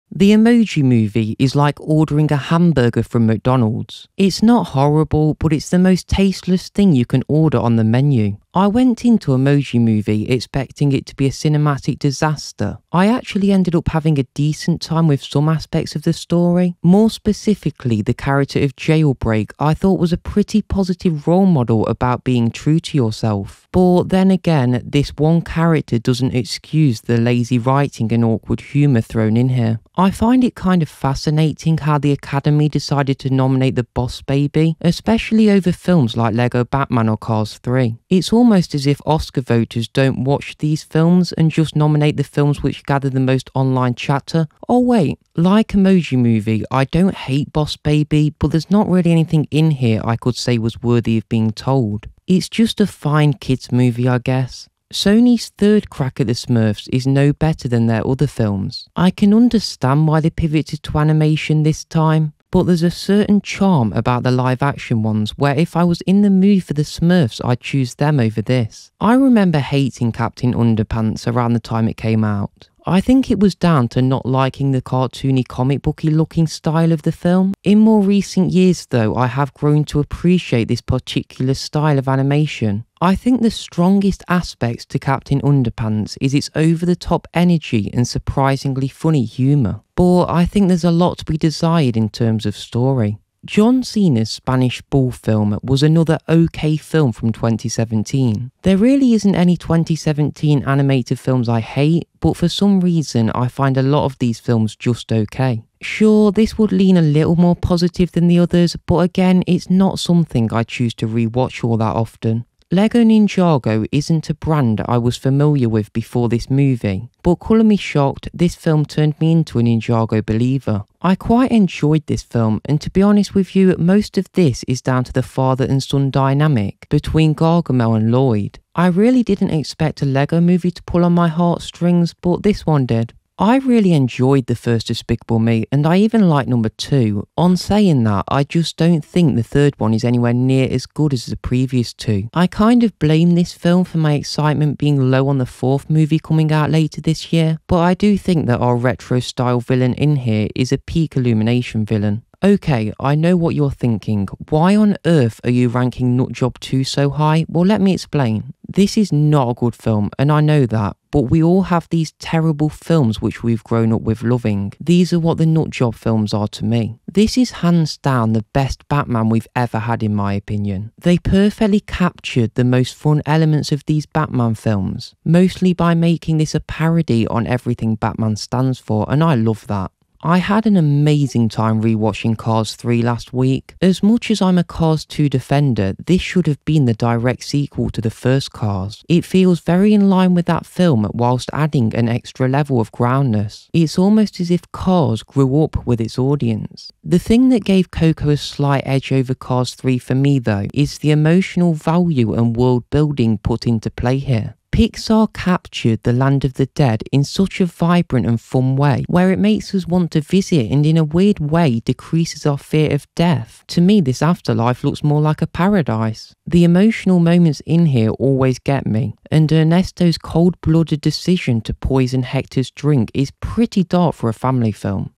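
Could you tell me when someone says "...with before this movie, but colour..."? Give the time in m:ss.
1:55.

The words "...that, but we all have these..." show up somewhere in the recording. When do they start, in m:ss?
2:40.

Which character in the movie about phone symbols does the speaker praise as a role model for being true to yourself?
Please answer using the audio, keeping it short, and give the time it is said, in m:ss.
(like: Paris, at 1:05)
Jailbreak, at 0:18.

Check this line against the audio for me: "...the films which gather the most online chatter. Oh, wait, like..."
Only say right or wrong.
right.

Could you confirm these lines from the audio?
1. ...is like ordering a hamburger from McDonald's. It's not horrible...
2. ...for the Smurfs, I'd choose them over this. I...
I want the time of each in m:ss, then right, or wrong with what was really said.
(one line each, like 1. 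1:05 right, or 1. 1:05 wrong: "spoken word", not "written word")
1. 0:01 right
2. 1:06 right.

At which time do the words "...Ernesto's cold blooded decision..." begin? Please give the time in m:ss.
3:39.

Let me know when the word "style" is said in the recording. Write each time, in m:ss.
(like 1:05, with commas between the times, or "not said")
1:16, 1:21, 2:29.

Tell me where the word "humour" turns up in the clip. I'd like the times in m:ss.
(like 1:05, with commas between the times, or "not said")
0:28, 1:29.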